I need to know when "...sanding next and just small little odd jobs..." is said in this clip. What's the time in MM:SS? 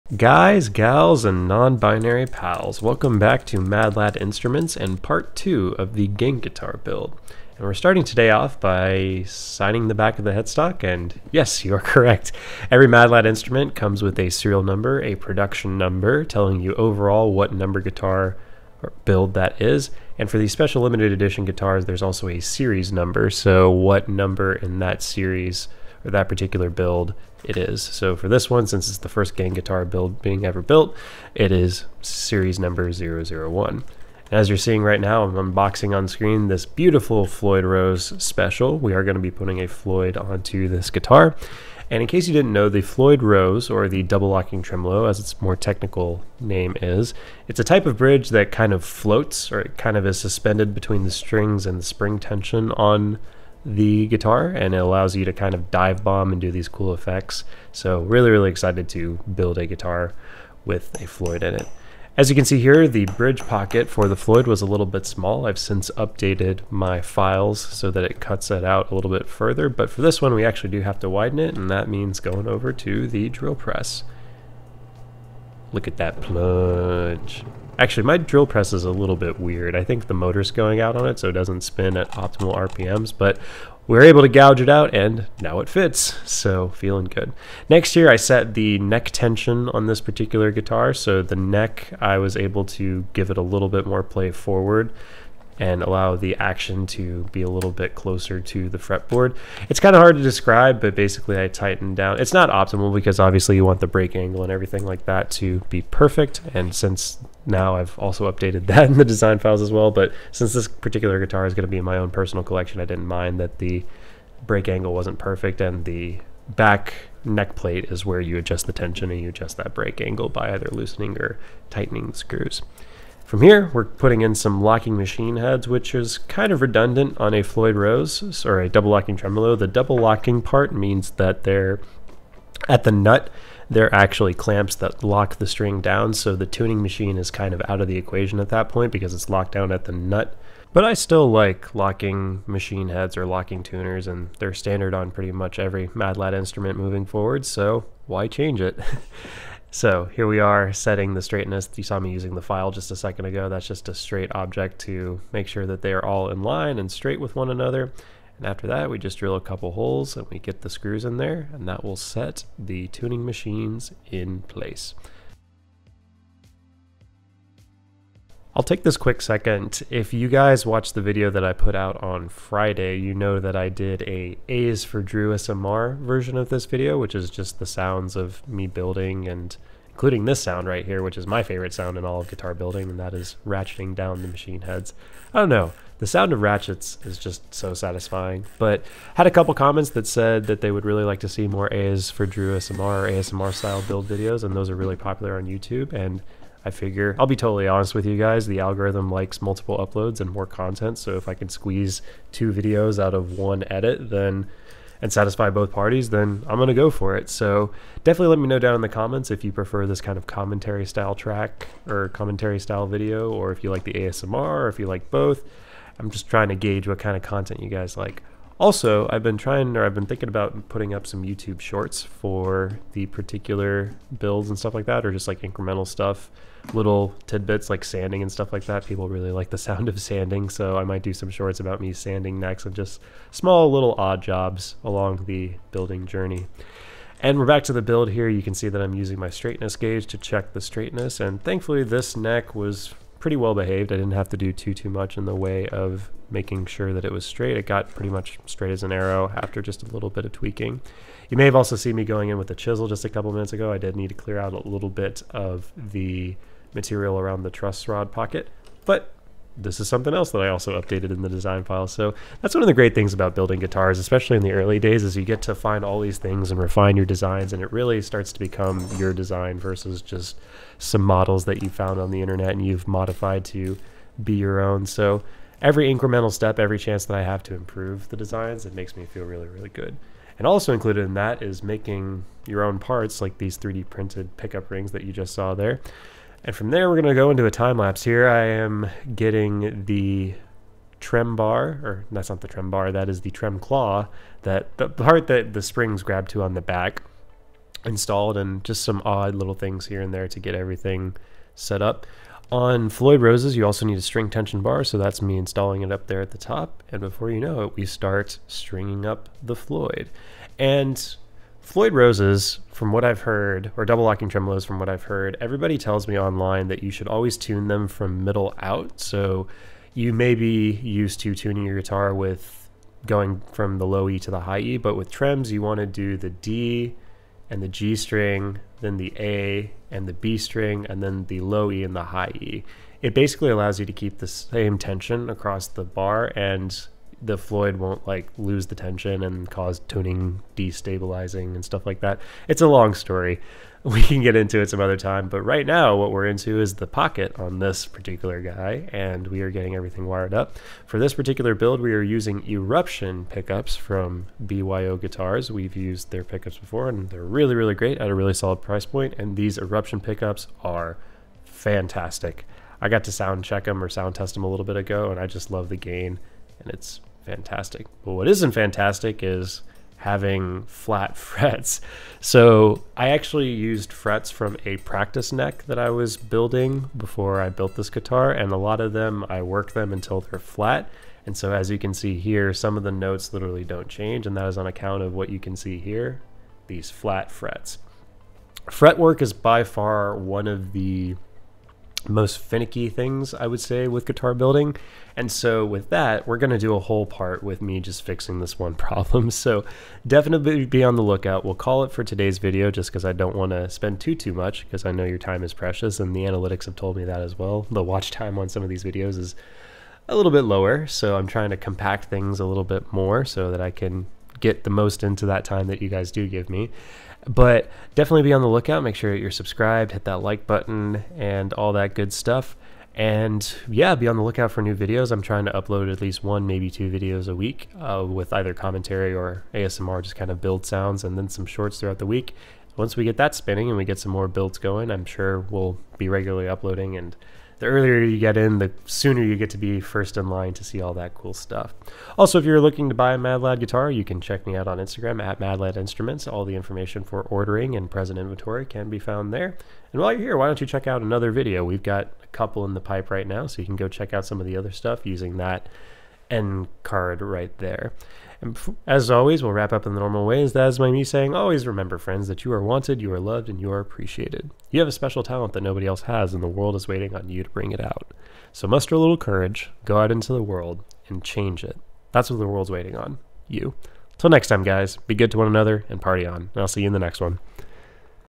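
03:51.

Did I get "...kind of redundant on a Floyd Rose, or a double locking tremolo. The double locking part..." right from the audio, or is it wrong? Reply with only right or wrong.
right.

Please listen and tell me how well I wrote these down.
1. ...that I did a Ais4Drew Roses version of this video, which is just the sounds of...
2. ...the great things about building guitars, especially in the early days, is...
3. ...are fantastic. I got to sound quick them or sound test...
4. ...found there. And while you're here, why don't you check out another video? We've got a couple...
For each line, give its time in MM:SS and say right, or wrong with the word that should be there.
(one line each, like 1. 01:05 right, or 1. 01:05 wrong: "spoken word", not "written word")
1. 02:53 wrong: "SMR", not "Roses"
2. 04:22 right
3. 06:00 wrong: "check", not "quick"
4. 07:28 right.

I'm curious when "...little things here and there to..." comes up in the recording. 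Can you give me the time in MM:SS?
04:59.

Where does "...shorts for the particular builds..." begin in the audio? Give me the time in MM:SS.
03:41.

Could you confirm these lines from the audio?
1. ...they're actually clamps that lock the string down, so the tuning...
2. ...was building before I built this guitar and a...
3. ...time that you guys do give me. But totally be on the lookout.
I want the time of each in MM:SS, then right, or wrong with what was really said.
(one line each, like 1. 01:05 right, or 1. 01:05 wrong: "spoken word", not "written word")
1. 02:13 right
2. 06:15 right
3. 06:55 wrong: "definitely", not "totally".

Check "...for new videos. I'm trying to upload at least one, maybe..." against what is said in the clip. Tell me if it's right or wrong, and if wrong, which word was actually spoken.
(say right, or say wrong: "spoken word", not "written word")
right.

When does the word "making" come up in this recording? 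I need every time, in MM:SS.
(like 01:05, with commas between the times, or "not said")
04:06, 04:41.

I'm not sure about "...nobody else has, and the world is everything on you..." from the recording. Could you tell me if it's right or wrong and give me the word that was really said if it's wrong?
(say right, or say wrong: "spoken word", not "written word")
wrong: "waiting", not "everything".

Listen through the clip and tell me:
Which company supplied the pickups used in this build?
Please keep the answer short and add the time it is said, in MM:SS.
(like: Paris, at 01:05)
BYO Guitars, at 05:54.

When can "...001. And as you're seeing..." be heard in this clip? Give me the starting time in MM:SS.
00:32.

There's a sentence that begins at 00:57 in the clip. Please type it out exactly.
So really, really excited to build a guitar with a Floyd in it.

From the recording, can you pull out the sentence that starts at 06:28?
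Fretwork is by far one of the most finicky things I would say with guitar building.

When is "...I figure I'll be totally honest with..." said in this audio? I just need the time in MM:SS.
03:16.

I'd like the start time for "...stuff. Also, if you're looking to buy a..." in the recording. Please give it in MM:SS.
07:21.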